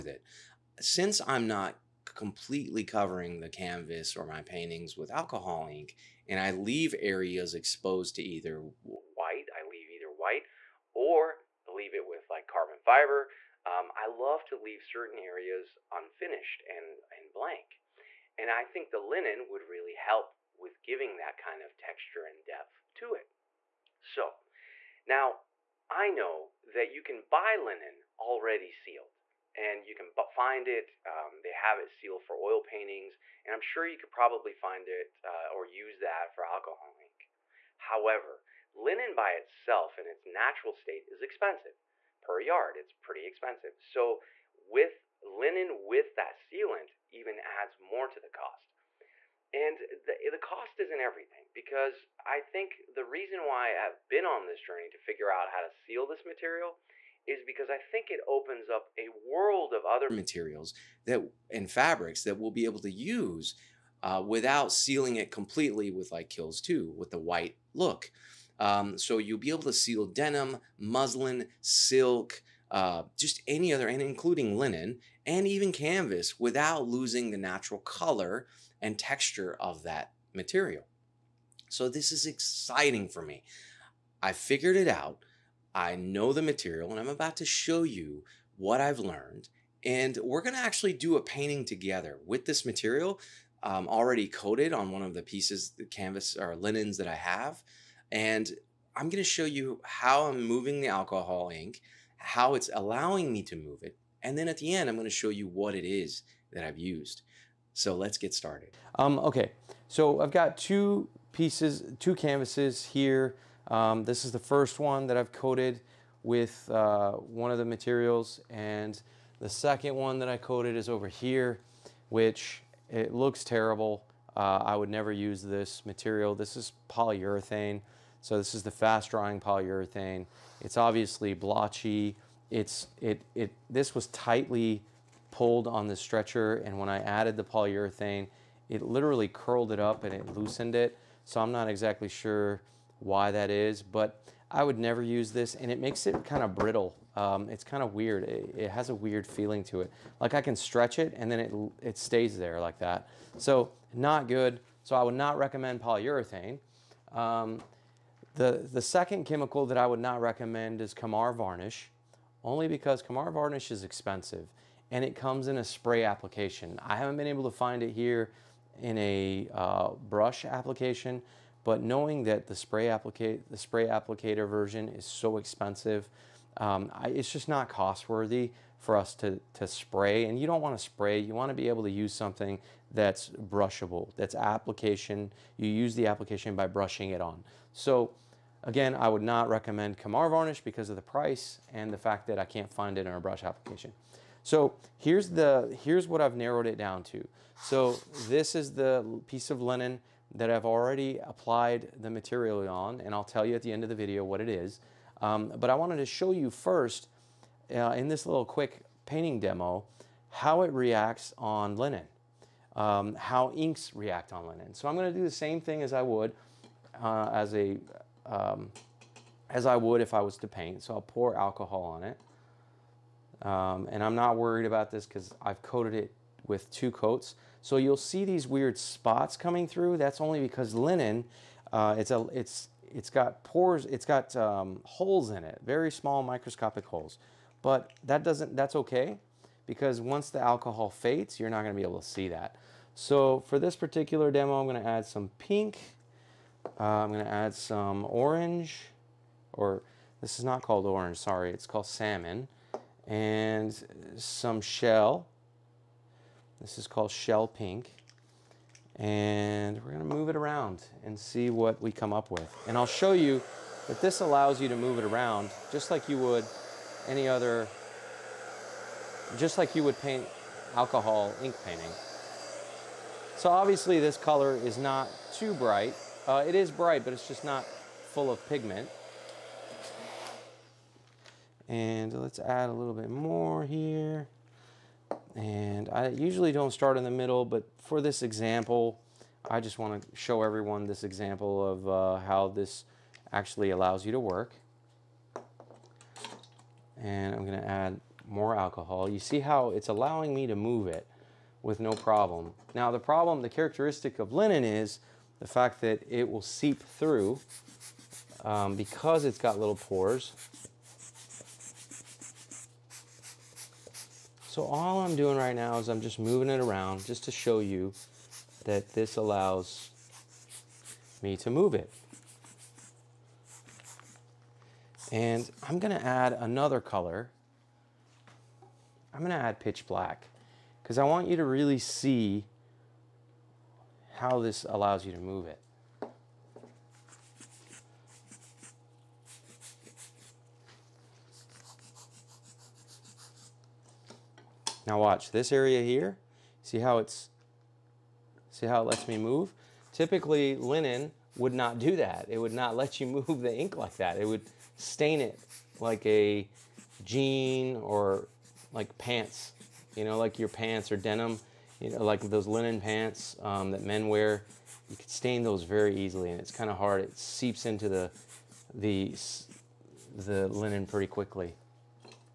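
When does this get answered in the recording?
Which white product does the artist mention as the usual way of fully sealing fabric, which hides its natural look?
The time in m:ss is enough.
1:06.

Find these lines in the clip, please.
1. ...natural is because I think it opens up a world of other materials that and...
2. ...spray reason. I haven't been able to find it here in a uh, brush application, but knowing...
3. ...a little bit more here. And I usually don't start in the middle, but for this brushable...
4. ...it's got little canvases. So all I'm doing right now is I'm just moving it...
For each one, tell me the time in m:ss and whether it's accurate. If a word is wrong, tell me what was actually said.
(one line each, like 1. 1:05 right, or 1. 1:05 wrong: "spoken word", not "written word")
1. 0:56 wrong: "material", not "natural"
2. 2:45 wrong: "application", not "reason"
3. 4:42 wrong: "example", not "brushable"
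4. 5:09 wrong: "pores", not "canvases".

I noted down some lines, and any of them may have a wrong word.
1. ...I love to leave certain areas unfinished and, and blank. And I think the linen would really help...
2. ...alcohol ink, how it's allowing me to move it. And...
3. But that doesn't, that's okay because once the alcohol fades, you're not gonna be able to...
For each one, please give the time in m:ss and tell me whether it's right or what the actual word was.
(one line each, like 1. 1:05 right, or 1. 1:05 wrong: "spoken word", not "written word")
1. 0:13 right
2. 1:40 right
3. 3:57 right.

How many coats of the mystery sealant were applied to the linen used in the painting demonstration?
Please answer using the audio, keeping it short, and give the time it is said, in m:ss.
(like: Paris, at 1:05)
2, at 3:46.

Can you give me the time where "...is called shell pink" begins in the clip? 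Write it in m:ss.
4:16.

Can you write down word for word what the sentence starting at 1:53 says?
Um, this is the first one that I've coated with uh, one of the materials.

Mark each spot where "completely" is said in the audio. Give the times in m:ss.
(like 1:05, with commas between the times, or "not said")
0:02, 1:05.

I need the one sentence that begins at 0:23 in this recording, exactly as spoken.
So now I know that you can buy linen already sealed and you can find it.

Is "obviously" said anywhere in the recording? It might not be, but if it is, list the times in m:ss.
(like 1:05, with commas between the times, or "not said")
2:10, 4:33.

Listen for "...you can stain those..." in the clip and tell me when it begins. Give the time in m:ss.
6:04.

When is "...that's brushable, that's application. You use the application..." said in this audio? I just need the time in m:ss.
3:02.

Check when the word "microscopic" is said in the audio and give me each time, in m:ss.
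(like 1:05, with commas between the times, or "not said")
3:56.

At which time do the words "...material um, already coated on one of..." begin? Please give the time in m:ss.
1:32.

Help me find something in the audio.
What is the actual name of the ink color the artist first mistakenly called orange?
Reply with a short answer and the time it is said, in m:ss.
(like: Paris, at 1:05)
Salmon, at 4:11.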